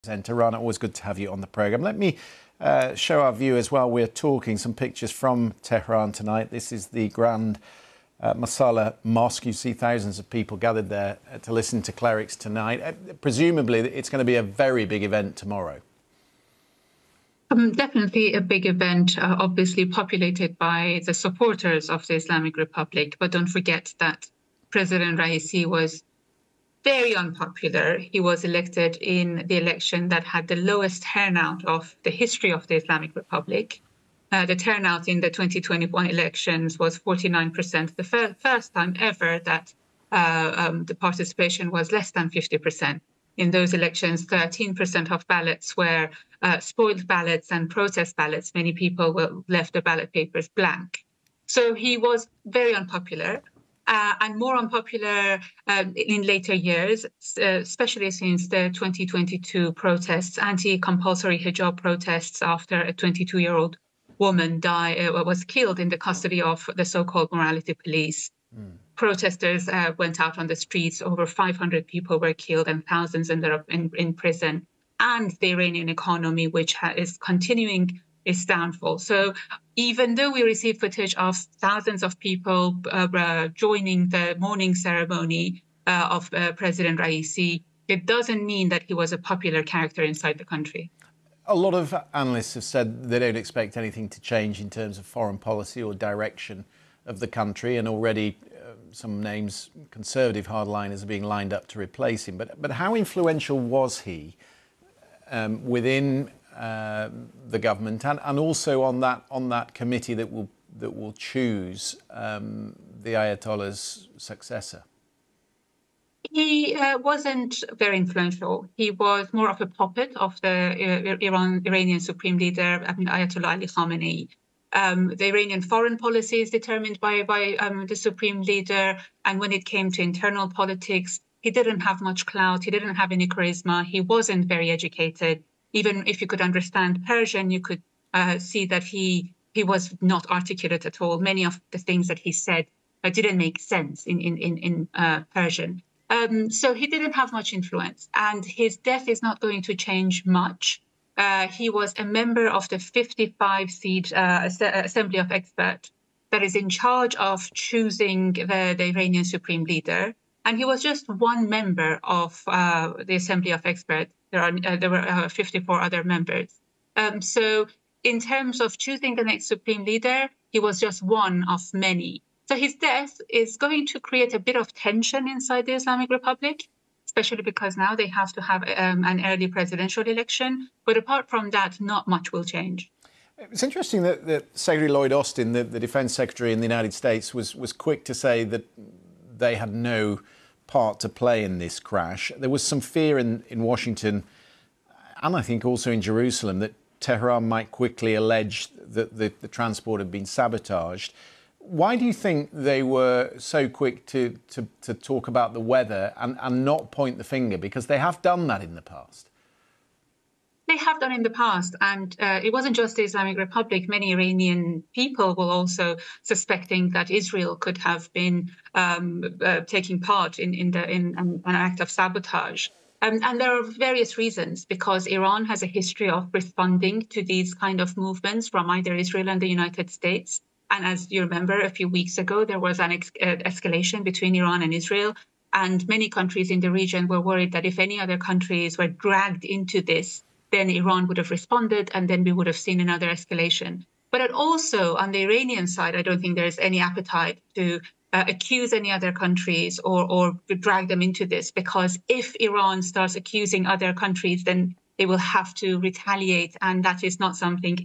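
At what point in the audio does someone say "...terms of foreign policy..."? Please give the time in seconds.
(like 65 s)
94 s.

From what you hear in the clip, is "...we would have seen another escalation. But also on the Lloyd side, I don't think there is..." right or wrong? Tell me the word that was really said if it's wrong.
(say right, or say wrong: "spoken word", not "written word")
wrong: "Iranian", not "Lloyd".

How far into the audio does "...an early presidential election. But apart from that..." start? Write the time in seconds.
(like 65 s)
179 s.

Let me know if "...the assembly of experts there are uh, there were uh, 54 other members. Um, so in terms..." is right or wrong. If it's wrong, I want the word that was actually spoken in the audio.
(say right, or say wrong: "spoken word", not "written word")
right.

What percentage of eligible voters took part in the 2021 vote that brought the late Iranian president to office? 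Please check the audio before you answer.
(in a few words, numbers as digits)
49%.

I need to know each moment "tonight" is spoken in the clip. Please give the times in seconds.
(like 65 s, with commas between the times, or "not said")
6 s, 12 s.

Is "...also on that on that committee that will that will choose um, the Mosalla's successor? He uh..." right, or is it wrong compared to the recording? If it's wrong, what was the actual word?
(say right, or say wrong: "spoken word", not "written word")
wrong: "Ayatollah", not "Mosalla".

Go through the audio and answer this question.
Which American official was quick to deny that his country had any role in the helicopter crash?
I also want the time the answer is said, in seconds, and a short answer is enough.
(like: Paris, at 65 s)
Lloyd Austin, at 184 s.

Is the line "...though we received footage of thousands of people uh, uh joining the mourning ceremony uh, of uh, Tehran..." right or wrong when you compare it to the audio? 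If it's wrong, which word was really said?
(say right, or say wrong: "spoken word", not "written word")
wrong: "President", not "Tehran".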